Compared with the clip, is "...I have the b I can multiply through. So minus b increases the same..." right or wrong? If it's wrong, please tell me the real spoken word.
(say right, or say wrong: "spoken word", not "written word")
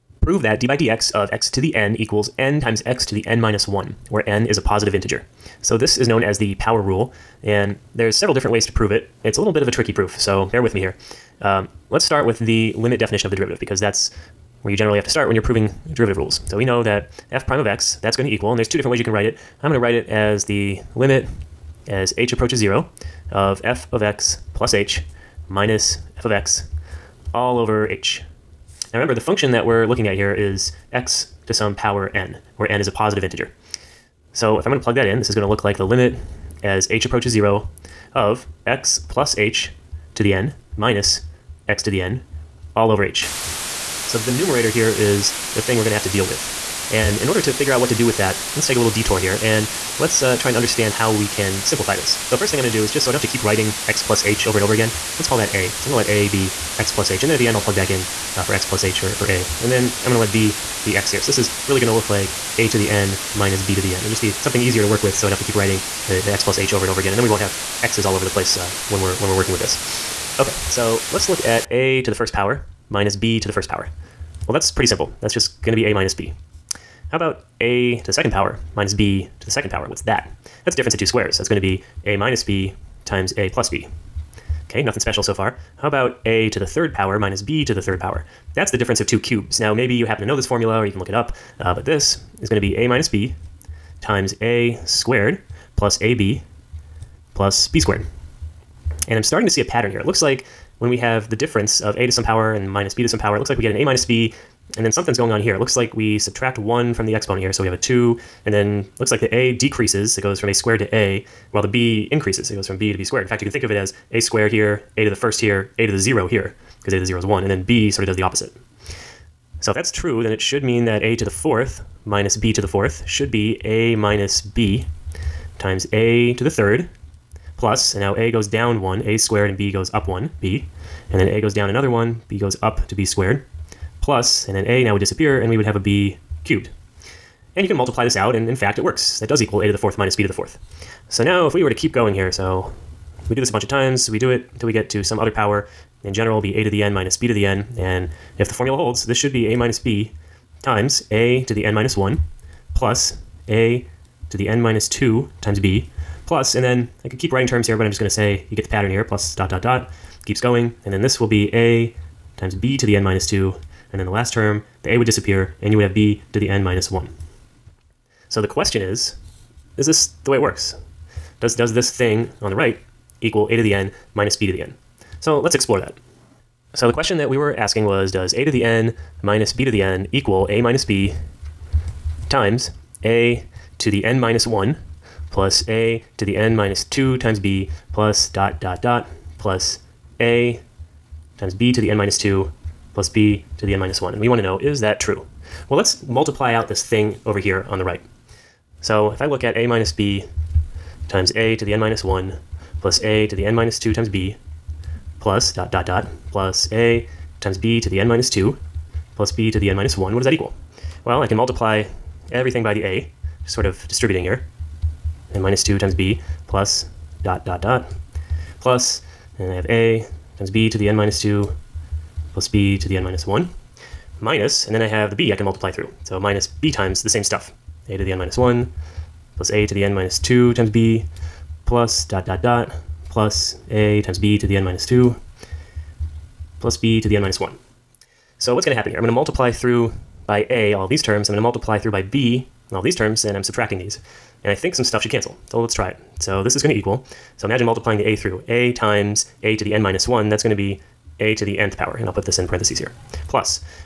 wrong: "times", not "increases".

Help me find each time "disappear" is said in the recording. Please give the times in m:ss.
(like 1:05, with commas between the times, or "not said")
2:14, 2:45.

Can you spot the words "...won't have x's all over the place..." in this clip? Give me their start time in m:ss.
1:07.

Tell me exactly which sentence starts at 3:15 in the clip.
Well, let's multiply out this thing over here on the right.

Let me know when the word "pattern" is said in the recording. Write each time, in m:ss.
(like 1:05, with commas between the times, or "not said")
1:39, 2:38.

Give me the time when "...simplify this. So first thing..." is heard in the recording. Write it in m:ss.
0:51.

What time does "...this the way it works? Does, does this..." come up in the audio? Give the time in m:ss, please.
2:49.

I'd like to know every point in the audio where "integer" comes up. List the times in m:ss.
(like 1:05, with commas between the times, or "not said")
0:04, 0:33.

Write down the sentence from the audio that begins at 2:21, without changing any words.
So now, if we were to keep going here, so we do this a bunch of times.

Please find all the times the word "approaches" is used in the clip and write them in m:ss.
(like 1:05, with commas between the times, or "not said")
0:22, 0:37.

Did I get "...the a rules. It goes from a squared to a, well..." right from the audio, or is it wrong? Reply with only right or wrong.
wrong.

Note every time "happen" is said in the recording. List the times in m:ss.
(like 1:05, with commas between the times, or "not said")
1:30, 3:58.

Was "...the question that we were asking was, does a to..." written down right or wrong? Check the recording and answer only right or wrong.
right.